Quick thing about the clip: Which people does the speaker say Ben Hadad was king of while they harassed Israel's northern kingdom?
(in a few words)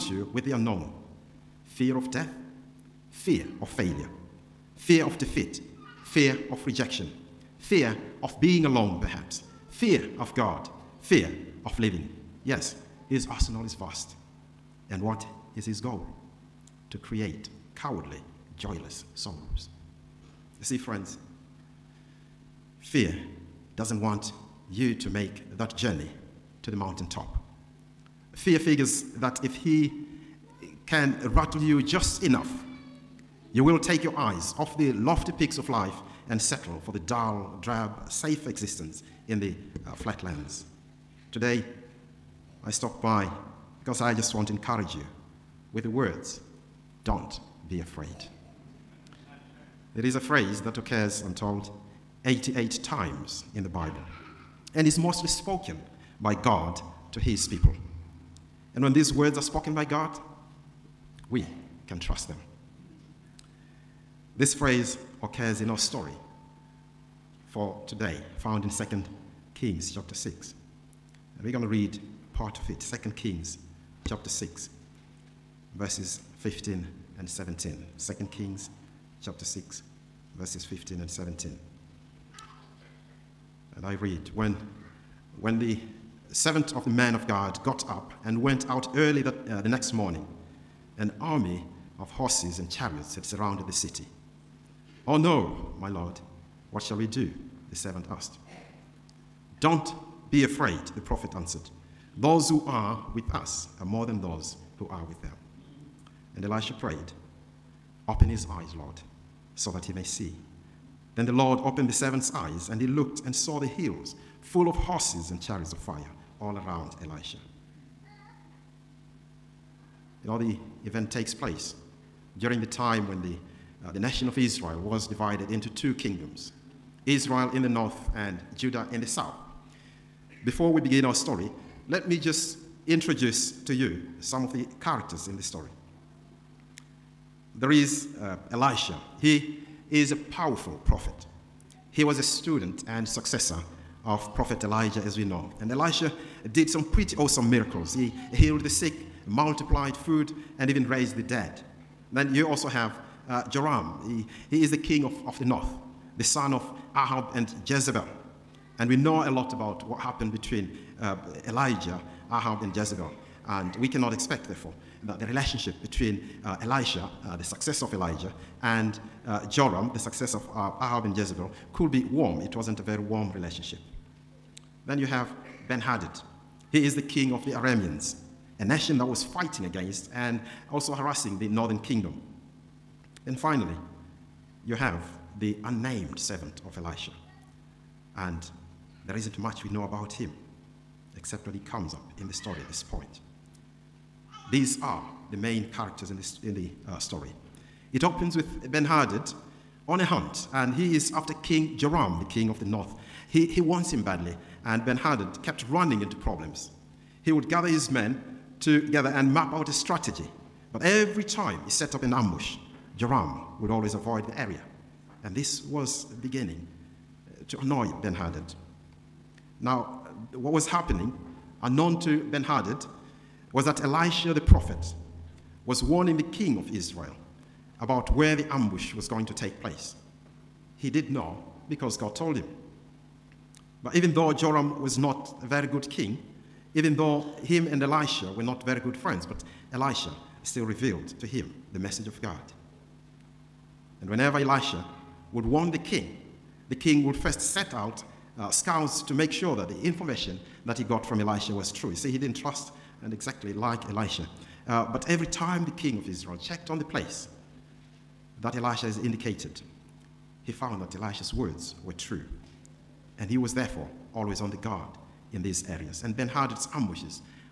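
Arameans.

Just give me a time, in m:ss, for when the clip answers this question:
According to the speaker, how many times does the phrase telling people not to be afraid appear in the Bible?
0:52.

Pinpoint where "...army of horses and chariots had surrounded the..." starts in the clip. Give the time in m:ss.
1:31.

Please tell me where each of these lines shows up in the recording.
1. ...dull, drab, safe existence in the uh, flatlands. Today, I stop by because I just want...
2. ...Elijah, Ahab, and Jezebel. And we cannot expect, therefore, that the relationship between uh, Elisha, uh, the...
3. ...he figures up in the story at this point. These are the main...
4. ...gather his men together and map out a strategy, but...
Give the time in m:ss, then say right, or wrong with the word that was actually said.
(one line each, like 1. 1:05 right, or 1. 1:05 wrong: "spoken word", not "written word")
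1. 0:36 right
2. 2:41 right
3. 3:11 wrong: "comes", not "figures"
4. 3:27 right.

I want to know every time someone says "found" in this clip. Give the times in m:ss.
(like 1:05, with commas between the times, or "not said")
1:08, 4:20.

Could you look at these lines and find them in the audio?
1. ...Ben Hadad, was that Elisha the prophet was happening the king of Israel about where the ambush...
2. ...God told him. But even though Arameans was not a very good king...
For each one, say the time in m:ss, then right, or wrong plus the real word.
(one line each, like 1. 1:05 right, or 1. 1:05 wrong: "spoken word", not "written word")
1. 3:42 wrong: "warning", not "happening"
2. 3:51 wrong: "Joram", not "Arameans".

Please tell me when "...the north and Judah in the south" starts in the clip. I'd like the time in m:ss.
2:07.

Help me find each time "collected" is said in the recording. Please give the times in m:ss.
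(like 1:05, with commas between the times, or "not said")
not said.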